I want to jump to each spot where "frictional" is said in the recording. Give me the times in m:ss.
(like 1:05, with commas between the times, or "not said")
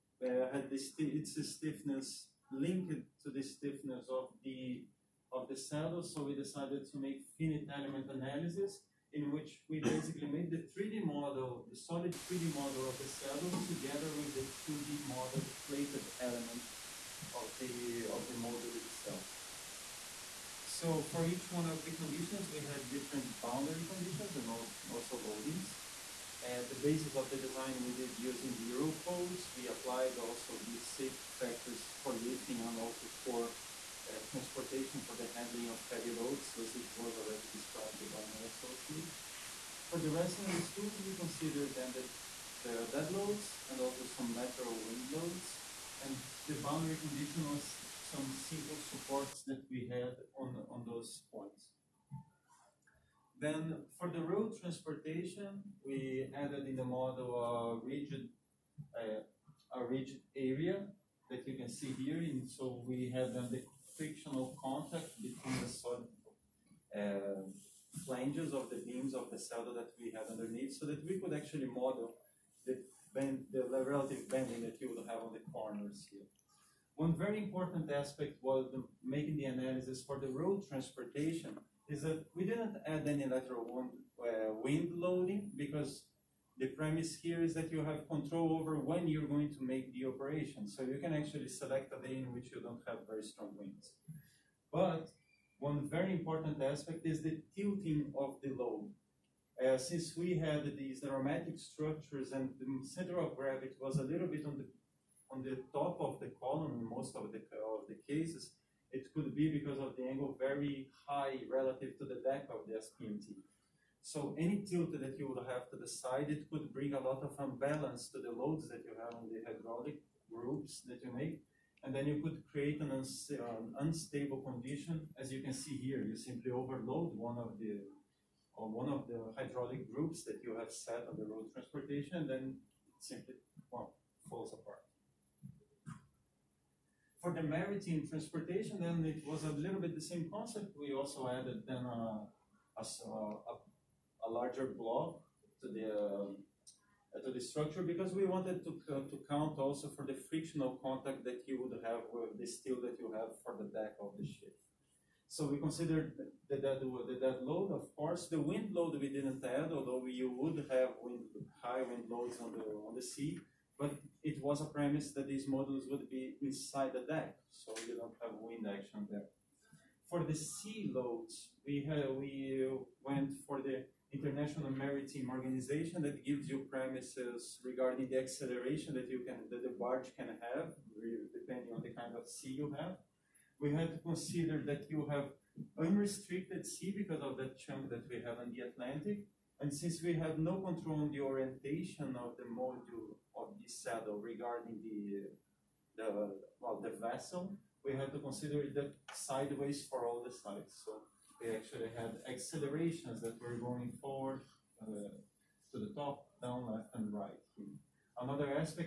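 1:03, 2:30.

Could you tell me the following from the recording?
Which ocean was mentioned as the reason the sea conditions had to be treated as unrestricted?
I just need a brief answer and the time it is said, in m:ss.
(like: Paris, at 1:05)
Atlantic, at 3:08.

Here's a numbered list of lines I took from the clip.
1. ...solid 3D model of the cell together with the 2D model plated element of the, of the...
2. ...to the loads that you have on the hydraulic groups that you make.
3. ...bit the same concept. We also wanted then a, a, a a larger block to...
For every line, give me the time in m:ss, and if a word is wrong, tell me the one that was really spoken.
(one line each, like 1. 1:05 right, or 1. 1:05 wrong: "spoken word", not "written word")
1. 0:11 right
2. 1:58 right
3. 2:19 wrong: "added", not "wanted".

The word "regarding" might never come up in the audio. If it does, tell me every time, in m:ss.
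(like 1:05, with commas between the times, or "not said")
2:57, 3:14.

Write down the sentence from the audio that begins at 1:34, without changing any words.
But one very important aspect is the tilting of the load.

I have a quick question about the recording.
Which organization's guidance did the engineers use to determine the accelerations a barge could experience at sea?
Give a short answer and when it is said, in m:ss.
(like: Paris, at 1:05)
International Maritime Organization, at 2:54.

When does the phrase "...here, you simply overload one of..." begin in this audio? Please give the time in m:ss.
2:05.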